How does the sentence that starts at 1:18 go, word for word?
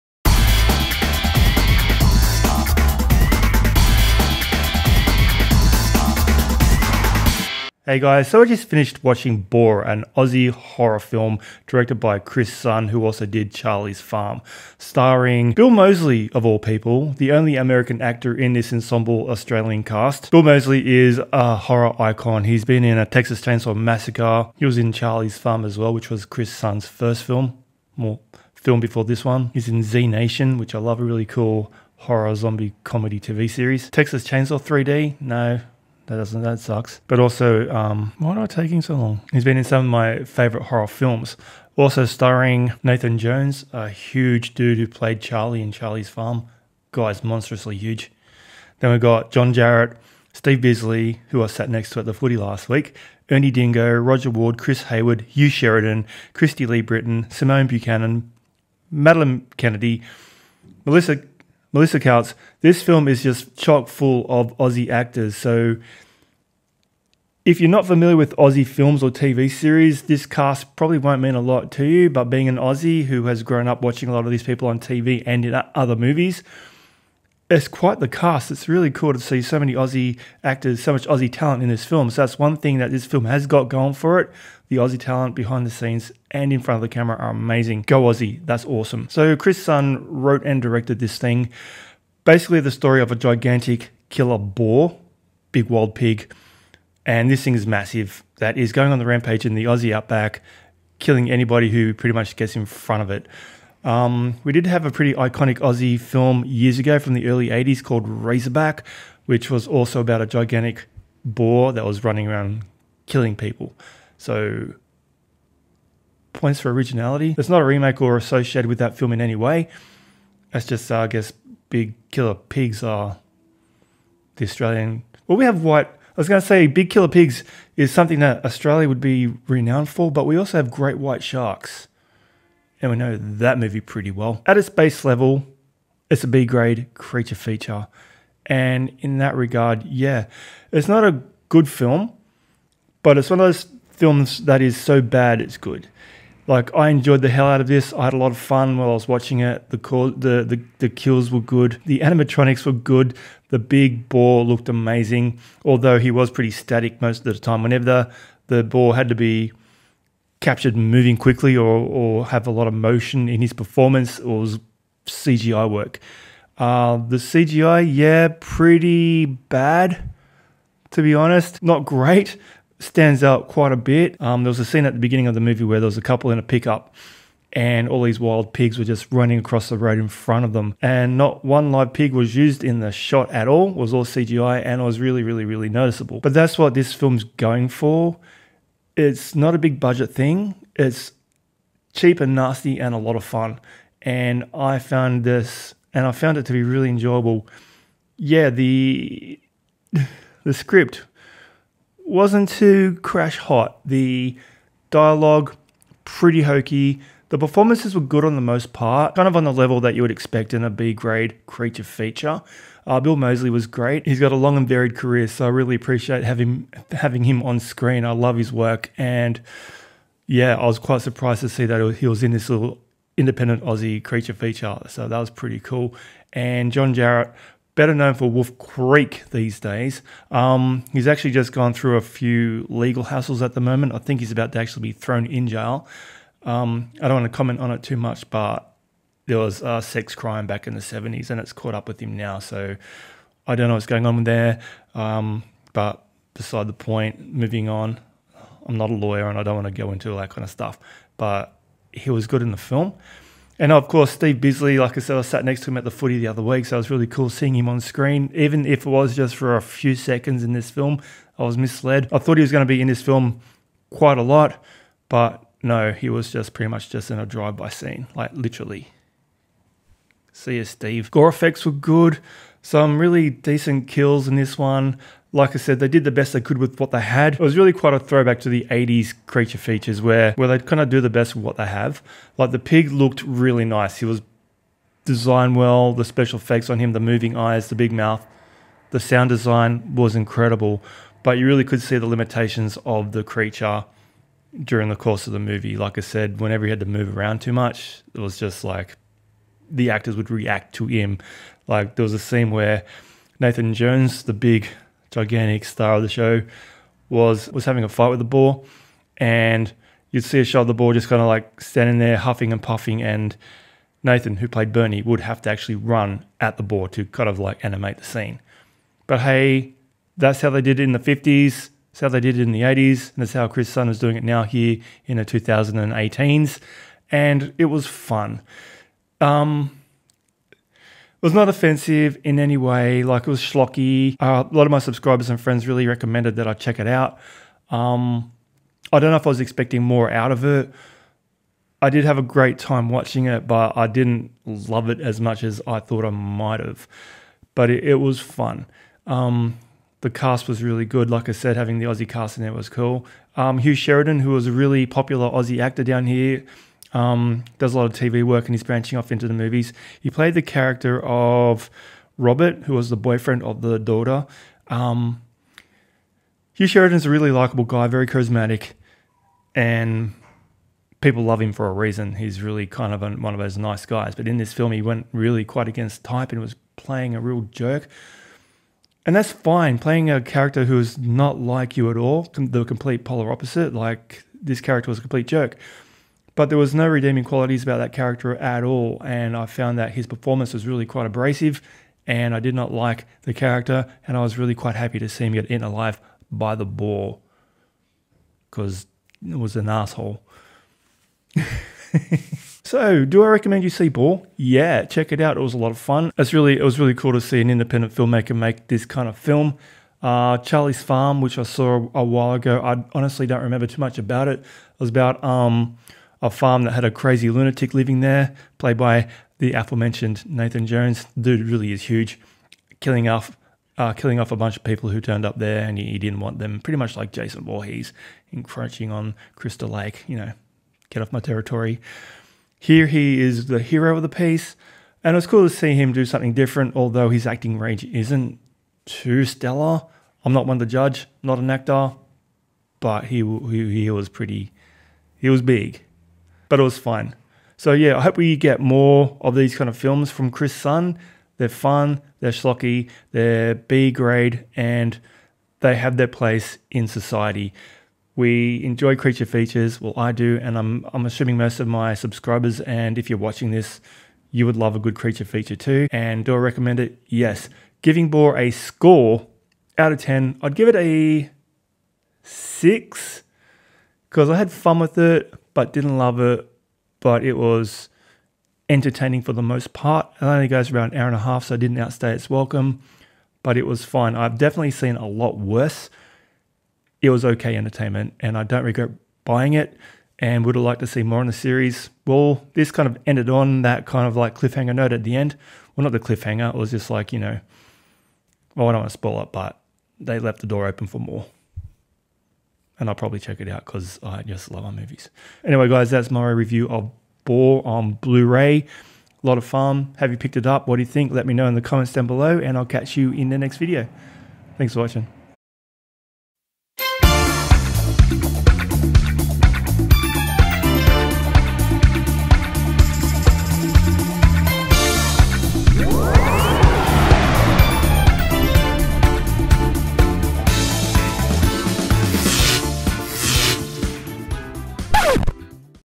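It's really cool to see so many Aussie actors, so much Aussie talent in this film.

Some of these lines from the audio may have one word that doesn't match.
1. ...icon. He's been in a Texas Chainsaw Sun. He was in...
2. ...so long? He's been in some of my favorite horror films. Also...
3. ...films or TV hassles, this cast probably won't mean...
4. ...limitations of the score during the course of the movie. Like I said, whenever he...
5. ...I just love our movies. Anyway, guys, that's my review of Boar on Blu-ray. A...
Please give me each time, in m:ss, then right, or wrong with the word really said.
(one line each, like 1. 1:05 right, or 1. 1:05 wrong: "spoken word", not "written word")
1. 0:21 wrong: "Massacre", not "Sun"
2. 0:38 right
3. 1:08 wrong: "series", not "hassles"
4. 4:52 wrong: "creature", not "score"
5. 8:24 right.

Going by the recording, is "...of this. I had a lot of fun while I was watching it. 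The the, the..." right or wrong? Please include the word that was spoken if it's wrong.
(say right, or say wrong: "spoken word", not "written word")
right.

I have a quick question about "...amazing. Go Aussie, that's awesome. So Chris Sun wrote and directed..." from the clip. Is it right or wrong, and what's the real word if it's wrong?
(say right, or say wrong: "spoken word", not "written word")
right.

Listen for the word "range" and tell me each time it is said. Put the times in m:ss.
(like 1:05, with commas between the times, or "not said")
7:17.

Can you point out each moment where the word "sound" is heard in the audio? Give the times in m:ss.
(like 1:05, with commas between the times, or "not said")
4:48.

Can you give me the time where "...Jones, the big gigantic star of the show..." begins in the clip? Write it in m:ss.
5:03.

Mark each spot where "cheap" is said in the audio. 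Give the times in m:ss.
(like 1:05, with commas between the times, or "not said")
3:11.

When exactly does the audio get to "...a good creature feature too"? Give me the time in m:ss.
7:44.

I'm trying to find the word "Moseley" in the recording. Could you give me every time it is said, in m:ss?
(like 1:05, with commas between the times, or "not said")
0:15, 0:20, 3:33.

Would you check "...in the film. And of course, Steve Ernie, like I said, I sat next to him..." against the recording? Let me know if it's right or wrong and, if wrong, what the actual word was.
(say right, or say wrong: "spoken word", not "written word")
wrong: "Bisley", not "Ernie".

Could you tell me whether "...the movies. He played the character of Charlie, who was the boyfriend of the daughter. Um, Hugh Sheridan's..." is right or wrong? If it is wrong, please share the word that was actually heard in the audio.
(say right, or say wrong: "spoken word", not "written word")
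wrong: "Robert", not "Charlie".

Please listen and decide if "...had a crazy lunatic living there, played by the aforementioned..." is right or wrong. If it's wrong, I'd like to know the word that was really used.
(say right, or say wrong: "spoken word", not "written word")
right.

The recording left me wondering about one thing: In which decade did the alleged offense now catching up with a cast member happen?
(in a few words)
the 70s.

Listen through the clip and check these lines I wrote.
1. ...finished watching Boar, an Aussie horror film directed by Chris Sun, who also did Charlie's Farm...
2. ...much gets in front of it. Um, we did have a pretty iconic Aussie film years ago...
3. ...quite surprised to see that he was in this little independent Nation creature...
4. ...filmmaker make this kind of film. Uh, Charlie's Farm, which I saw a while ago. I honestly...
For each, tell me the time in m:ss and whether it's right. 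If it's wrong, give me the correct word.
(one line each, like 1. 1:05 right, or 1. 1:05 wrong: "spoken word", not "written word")
1. 0:08 right
2. 1:42 right
3. 3:40 wrong: "Aussie", not "Nation"
4. 6:47 right.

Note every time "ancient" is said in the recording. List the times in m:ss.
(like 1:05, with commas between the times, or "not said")
not said.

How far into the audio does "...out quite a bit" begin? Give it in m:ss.
2:53.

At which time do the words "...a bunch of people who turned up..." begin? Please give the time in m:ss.
7:04.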